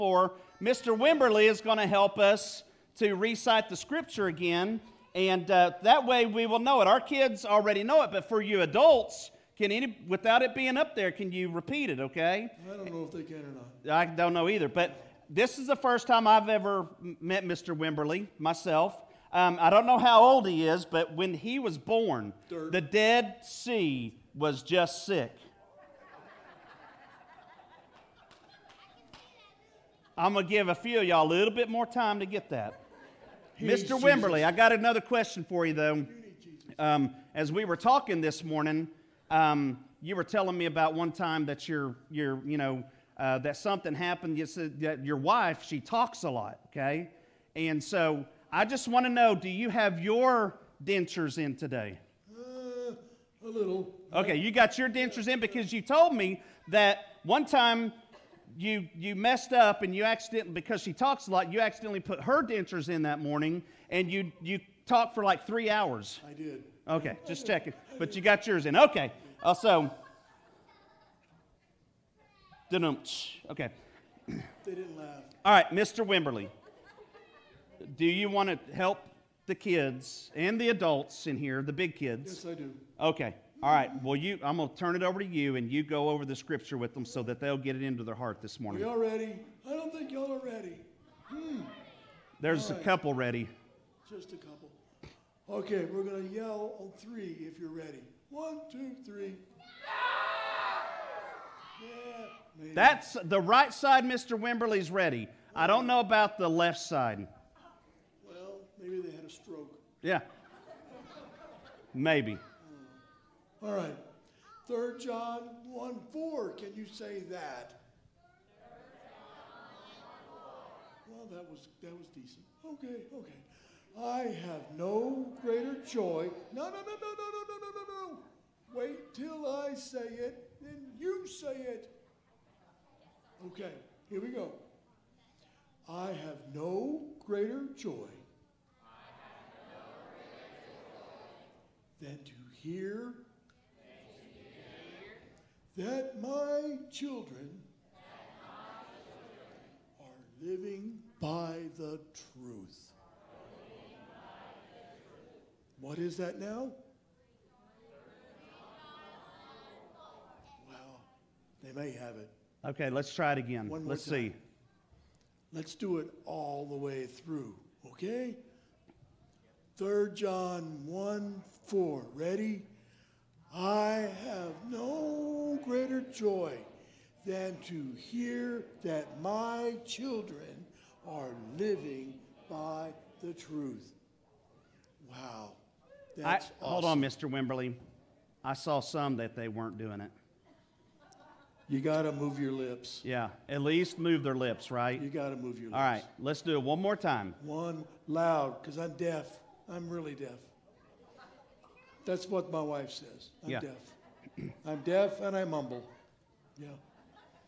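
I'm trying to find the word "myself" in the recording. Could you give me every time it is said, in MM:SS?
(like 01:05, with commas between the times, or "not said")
00:18.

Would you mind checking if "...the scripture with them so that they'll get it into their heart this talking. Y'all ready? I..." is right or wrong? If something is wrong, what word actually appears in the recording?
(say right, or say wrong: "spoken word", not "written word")
wrong: "morning", not "talking".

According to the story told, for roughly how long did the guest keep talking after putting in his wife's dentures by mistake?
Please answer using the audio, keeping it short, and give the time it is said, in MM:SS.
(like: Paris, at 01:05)
3 hours, at 01:05.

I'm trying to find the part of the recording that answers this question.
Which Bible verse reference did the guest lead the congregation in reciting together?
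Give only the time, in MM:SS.
01:54.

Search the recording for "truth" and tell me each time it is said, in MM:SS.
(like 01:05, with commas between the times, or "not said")
02:32, 03:03.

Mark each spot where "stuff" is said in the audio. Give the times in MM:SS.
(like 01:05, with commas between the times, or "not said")
not said.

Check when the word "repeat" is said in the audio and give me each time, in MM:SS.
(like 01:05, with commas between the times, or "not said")
00:11.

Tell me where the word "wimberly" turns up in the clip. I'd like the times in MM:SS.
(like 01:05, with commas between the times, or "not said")
00:00, 00:17, 00:33, 01:16, 01:44, 03:07.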